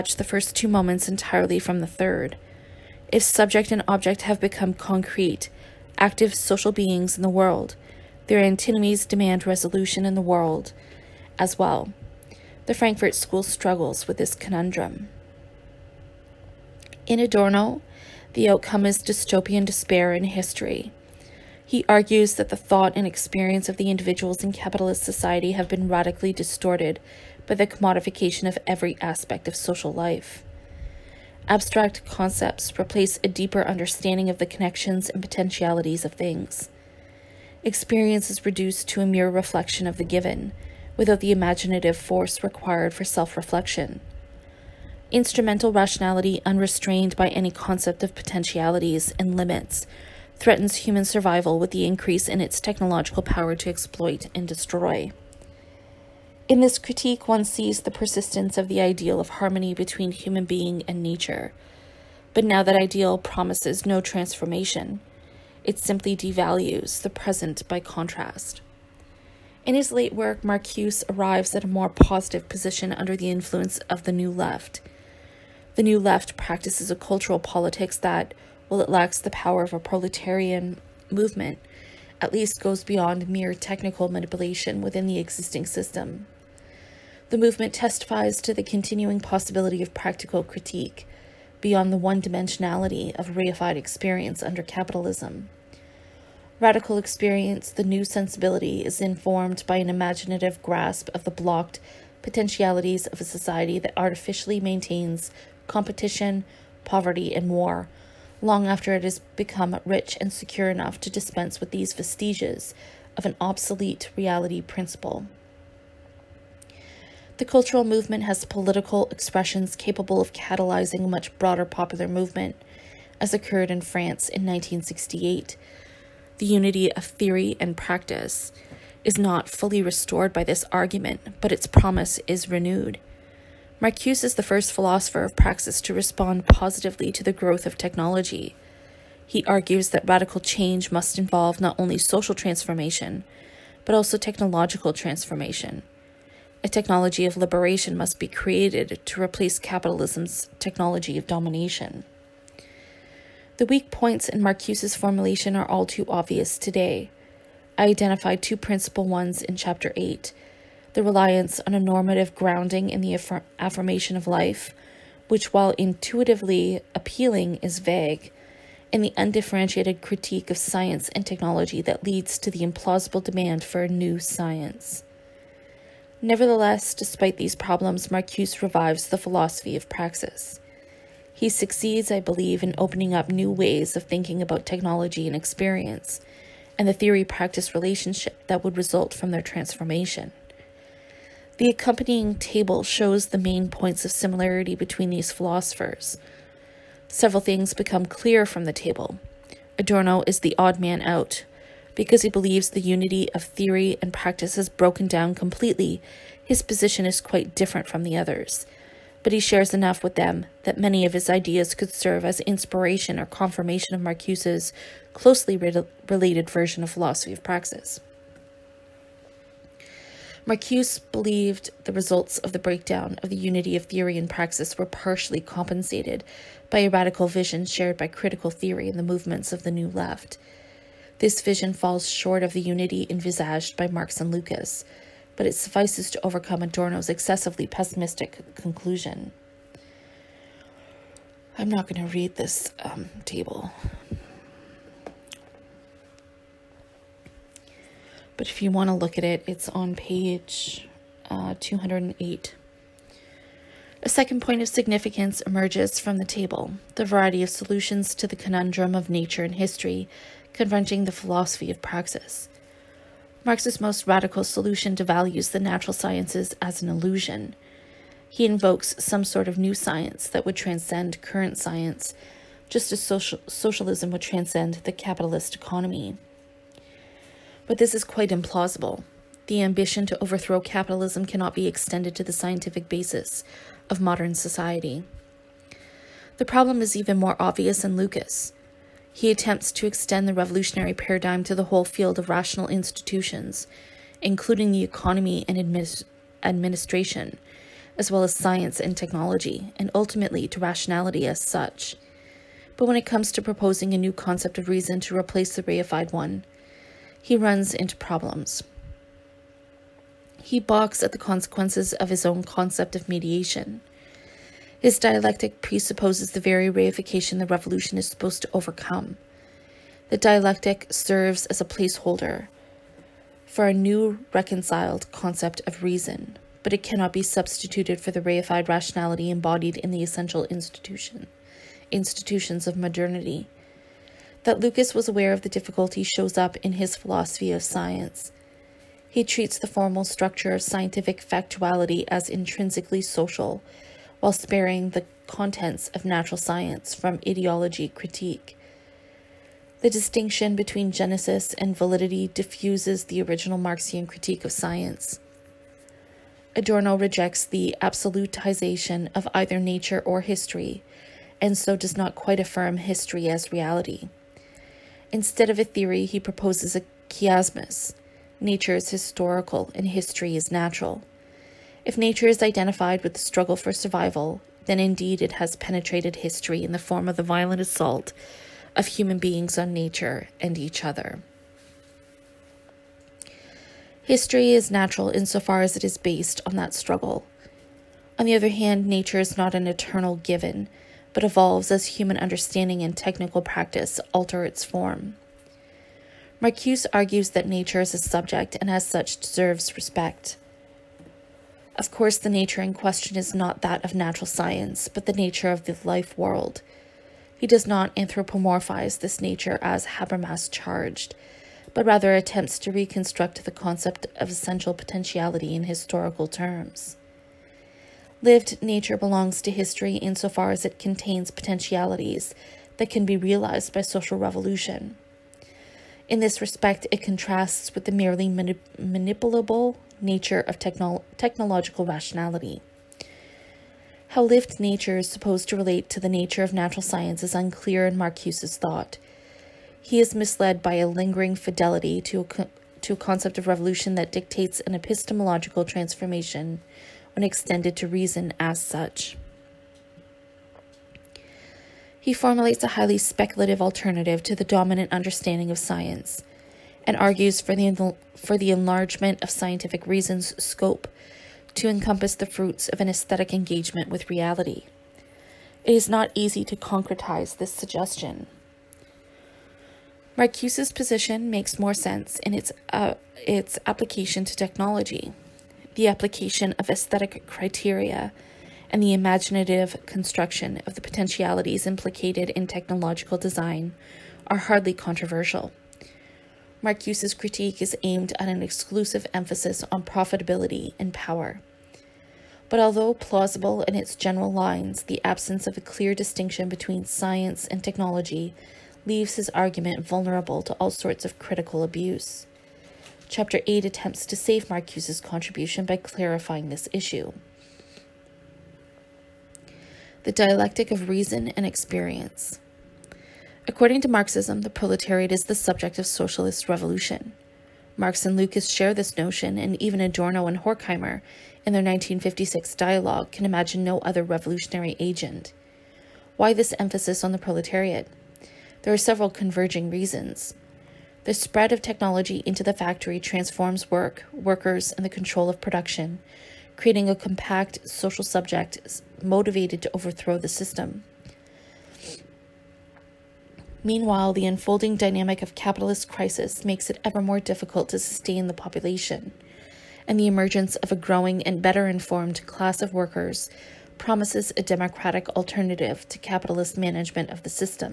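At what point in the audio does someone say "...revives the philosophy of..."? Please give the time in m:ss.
2:58.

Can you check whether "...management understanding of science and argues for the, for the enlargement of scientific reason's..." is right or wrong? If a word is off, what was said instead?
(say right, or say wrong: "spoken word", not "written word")
wrong: "dominant", not "management".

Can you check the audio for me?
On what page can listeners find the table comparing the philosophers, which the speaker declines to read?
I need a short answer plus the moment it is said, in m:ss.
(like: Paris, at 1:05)
208, at 4:11.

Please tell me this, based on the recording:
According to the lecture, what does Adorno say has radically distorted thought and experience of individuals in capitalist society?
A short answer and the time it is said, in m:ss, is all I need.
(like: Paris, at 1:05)
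commodification, at 0:27.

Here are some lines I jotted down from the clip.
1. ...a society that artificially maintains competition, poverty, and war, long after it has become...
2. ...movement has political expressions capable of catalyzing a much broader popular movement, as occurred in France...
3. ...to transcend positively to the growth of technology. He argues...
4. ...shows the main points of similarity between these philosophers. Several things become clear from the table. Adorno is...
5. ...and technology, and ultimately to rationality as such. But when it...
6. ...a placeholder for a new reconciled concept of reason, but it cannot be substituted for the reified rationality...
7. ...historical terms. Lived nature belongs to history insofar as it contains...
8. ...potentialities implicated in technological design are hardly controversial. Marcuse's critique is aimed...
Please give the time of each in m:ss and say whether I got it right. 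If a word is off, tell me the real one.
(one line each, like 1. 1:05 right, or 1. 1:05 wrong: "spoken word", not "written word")
1. 1:43 right
2. 1:57 right
3. 2:15 wrong: "respond", not "transcend"
4. 3:12 right
5. 4:58 right
6. 5:21 right
7. 6:55 right
8. 8:00 right.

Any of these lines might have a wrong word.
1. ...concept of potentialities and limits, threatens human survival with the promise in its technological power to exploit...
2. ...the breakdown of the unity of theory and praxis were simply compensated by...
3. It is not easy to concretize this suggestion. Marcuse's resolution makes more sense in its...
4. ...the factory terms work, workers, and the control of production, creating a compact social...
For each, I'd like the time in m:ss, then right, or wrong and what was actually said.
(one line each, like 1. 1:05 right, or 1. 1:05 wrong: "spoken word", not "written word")
1. 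0:47 wrong: "increase", not "promise"
2. 3:42 wrong: "partially", not "simply"
3. 7:45 wrong: "position", not "resolution"
4. 8:52 wrong: "transforms", not "terms".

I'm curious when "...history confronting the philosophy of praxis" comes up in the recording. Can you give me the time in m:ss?
4:19.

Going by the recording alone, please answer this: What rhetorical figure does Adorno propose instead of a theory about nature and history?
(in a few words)
a chiasmus.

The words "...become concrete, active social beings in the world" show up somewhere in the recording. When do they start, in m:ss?
0:04.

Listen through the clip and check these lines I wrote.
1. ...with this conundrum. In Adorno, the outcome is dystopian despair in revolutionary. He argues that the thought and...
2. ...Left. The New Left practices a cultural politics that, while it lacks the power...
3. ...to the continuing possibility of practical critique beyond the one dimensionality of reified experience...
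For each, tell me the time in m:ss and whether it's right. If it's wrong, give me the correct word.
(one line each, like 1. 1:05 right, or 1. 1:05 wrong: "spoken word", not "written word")
1. 0:14 wrong: "history", not "revolutionary"
2. 1:14 right
3. 1:28 right.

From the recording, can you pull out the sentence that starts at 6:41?
Of course, the nature in question is not that of natural science, but the nature of the life world.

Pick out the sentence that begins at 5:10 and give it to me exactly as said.
He balks at the consequences of his own concept of mediation.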